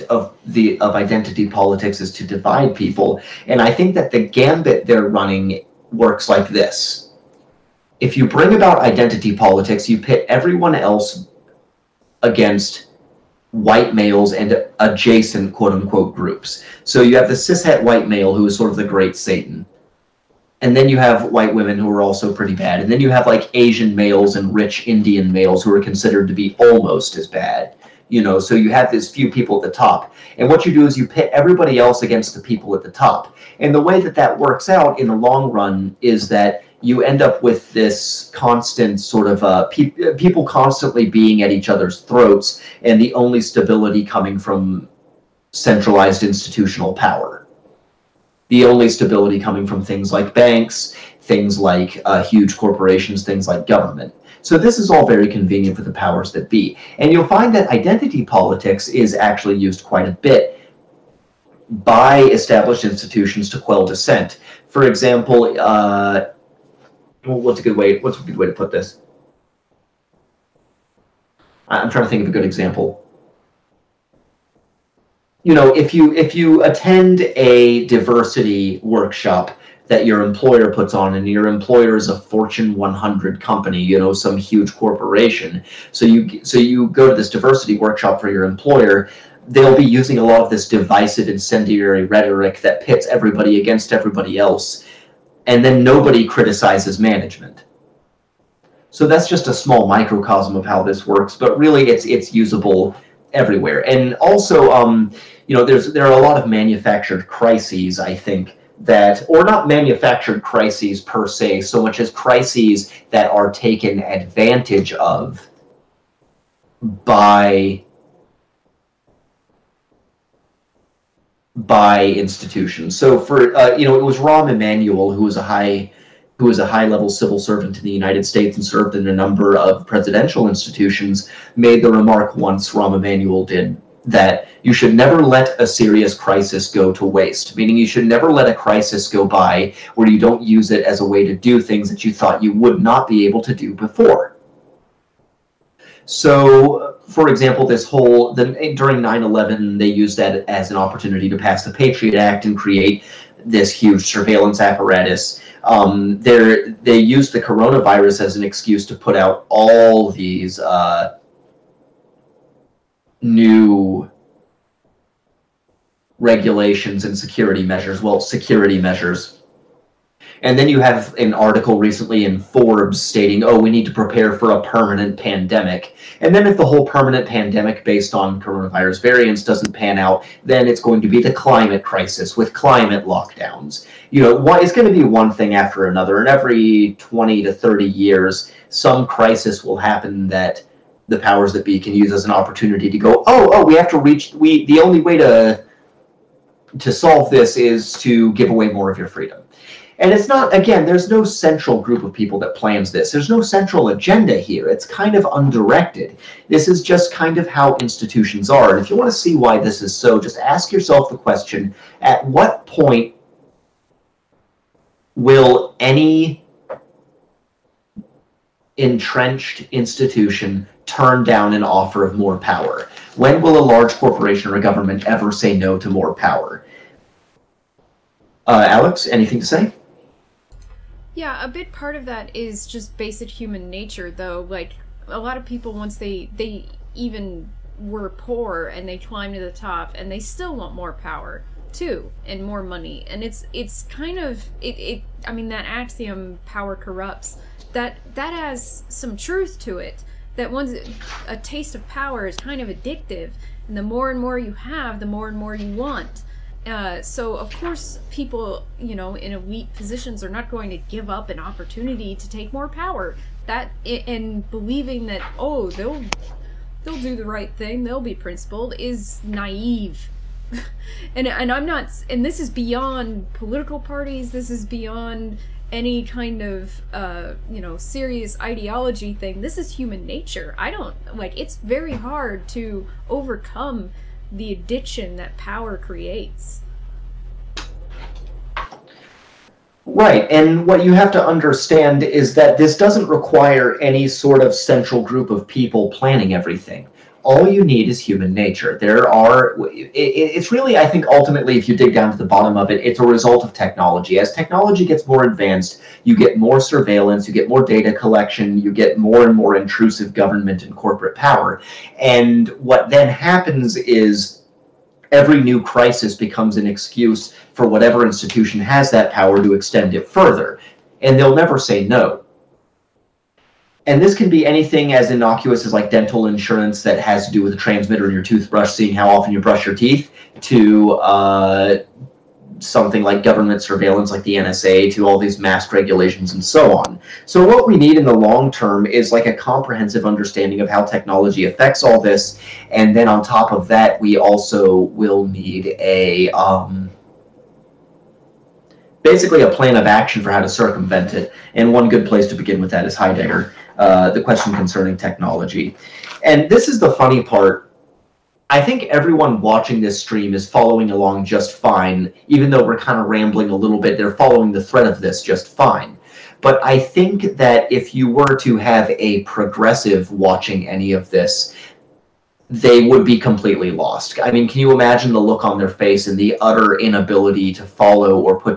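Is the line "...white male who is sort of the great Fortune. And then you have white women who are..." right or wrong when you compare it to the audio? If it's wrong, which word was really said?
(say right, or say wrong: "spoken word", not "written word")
wrong: "Satan", not "Fortune".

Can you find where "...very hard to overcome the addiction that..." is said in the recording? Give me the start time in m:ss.
4:41.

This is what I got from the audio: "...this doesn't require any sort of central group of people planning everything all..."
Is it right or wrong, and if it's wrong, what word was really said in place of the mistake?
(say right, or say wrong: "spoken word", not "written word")
right.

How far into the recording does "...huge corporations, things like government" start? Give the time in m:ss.
0:52.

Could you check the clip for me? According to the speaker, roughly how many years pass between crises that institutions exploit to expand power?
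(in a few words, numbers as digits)
20 to 30.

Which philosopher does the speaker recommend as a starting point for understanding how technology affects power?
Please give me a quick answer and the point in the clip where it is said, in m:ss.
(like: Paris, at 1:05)
Heidegger, at 5:52.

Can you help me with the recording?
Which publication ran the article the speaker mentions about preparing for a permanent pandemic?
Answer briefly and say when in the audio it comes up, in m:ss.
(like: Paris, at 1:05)
Forbes, at 2:52.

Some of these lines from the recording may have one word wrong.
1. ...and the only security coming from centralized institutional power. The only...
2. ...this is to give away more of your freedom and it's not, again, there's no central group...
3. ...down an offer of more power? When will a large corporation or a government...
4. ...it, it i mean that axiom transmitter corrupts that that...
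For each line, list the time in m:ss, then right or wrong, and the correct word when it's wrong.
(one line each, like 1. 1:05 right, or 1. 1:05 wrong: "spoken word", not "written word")
1. 0:42 wrong: "stability", not "security"
2. 3:17 right
3. 3:41 right
4. 4:04 wrong: "power", not "transmitter".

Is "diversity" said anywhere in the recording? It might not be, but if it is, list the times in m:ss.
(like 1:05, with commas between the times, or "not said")
1:17, 1:27.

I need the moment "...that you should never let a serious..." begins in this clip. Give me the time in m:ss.
2:14.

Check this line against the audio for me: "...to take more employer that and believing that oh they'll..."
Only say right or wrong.
wrong.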